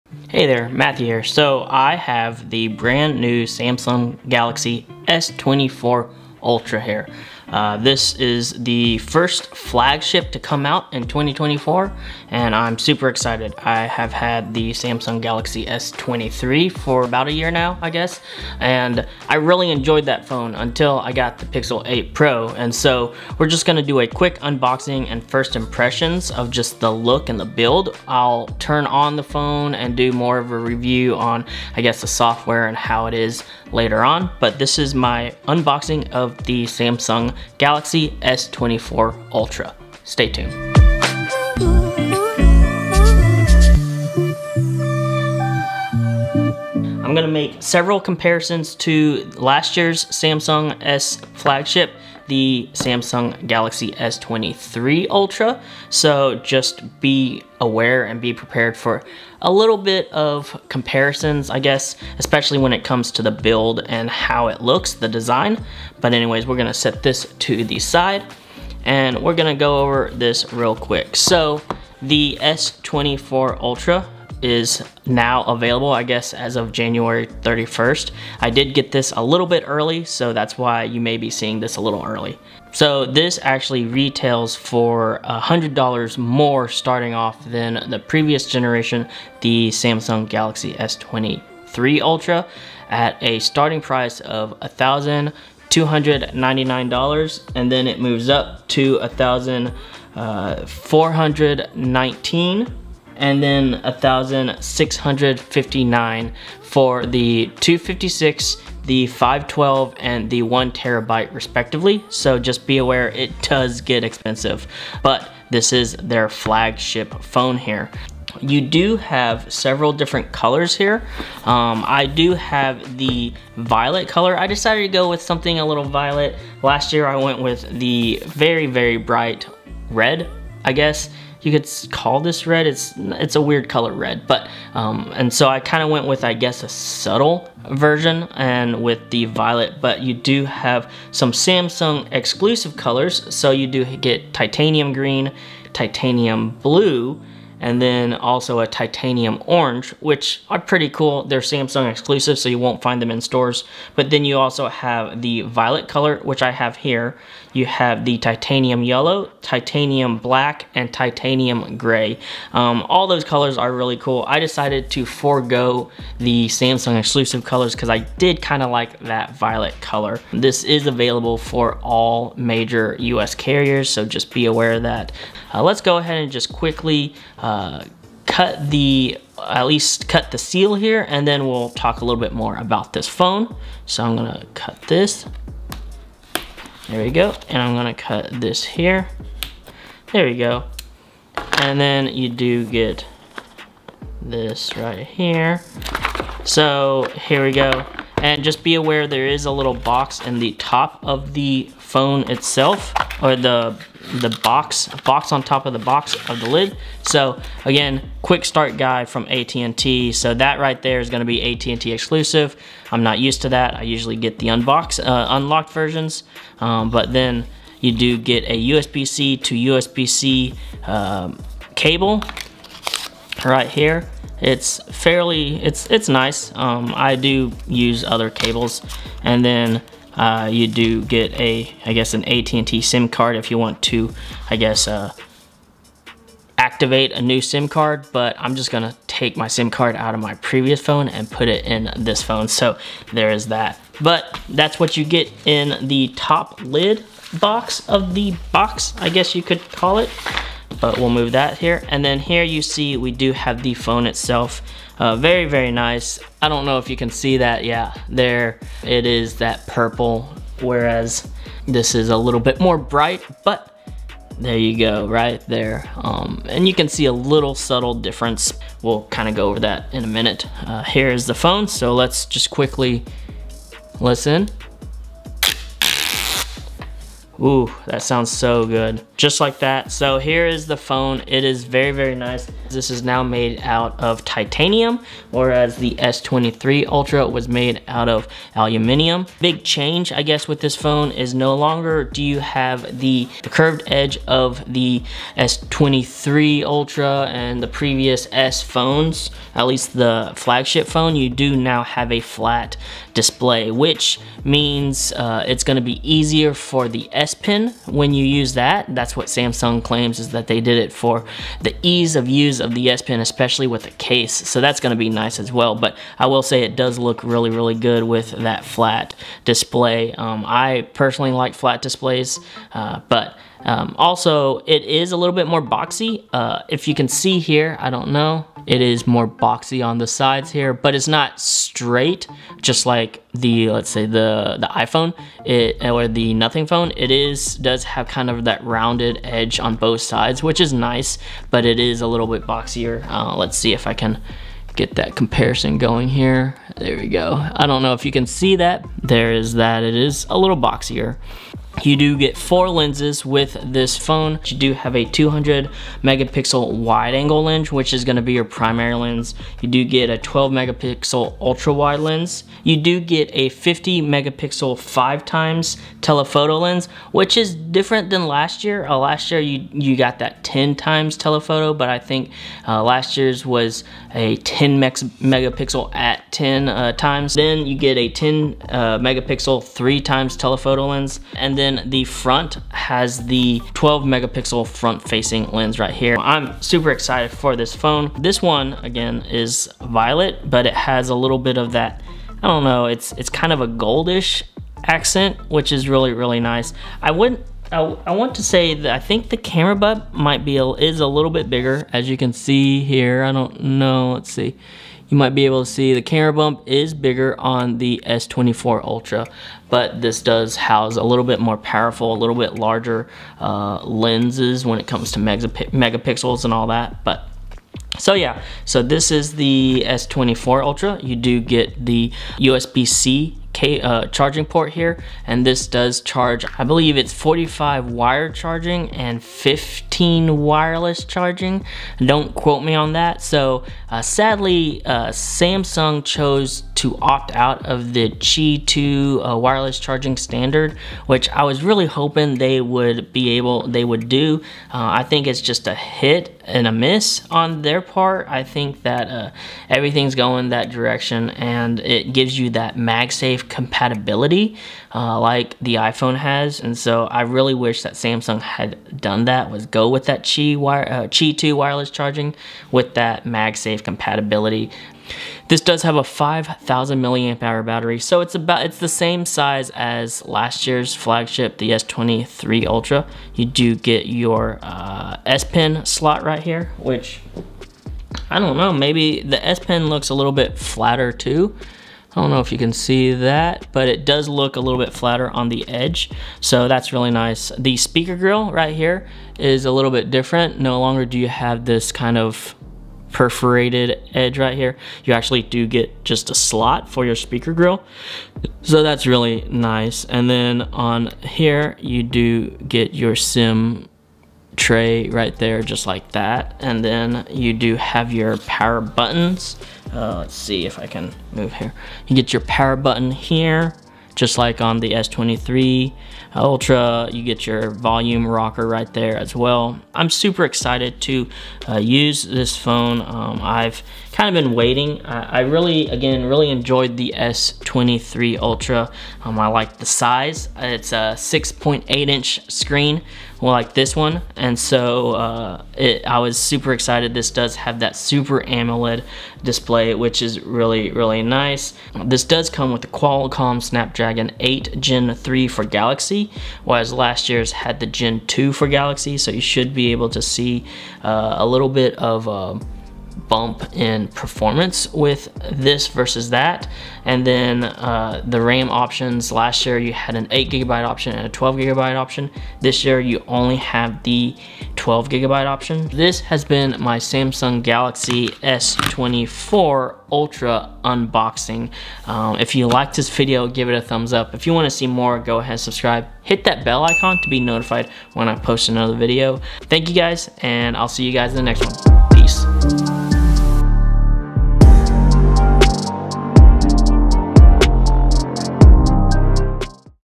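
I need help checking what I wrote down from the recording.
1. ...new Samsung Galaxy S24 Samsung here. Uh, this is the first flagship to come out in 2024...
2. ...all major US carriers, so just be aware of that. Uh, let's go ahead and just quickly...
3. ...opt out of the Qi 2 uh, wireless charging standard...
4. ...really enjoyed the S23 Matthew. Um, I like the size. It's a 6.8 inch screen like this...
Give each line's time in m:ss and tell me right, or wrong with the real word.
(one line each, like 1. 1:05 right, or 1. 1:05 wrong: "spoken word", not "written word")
1. 0:03 wrong: "Ultra", not "Samsung"
2. 2:51 right
3. 7:17 right
4. 8:46 wrong: "Ultra", not "Matthew".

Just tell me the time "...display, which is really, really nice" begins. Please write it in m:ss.
8:59.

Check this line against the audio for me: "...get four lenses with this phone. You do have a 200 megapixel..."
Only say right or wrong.
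right.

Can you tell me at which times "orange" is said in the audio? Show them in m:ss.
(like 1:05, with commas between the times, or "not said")
2:29.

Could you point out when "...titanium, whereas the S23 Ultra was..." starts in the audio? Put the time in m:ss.
4:44.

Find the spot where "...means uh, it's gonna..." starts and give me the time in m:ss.
5:04.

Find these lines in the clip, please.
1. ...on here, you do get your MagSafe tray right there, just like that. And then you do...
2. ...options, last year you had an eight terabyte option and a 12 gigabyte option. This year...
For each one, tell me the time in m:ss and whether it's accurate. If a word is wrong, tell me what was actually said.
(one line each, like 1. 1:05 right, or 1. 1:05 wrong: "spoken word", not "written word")
1. 8:20 wrong: "SIM", not "MagSafe"
2. 9:18 wrong: "gigabyte", not "terabyte".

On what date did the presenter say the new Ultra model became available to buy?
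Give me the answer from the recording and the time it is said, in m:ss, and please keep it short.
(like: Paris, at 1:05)
January 31st, at 1:16.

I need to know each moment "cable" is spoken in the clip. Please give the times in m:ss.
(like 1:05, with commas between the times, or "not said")
3:41, 3:48.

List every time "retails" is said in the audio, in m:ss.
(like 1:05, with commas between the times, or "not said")
1:23.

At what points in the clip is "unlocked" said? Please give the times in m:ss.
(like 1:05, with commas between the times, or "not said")
3:35.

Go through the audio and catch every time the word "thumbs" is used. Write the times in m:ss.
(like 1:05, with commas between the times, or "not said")
9:33.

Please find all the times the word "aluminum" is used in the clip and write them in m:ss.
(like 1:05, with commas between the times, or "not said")
4:48.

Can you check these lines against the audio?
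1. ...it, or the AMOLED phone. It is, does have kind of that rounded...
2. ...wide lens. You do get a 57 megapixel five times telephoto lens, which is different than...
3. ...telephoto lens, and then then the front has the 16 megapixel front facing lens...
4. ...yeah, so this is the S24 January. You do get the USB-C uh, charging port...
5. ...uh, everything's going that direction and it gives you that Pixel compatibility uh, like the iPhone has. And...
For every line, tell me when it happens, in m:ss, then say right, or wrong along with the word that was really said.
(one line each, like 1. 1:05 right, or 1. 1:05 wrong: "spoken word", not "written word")
1. 5:35 wrong: "Nothing", not "AMOLED"
2. 6:01 wrong: "50", not "57"
3. 6:20 wrong: "12", not "16"
4. 6:58 wrong: "Ultra", not "January"
5. 7:29 wrong: "MagSafe", not "Pixel".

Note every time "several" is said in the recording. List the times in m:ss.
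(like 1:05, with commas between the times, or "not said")
0:47, 1:59.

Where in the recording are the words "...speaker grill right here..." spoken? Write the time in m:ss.
8:07.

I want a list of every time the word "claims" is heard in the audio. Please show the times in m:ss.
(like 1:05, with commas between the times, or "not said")
5:09.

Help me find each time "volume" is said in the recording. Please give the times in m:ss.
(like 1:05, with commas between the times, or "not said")
8:37.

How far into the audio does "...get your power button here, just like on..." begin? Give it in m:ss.
8:32.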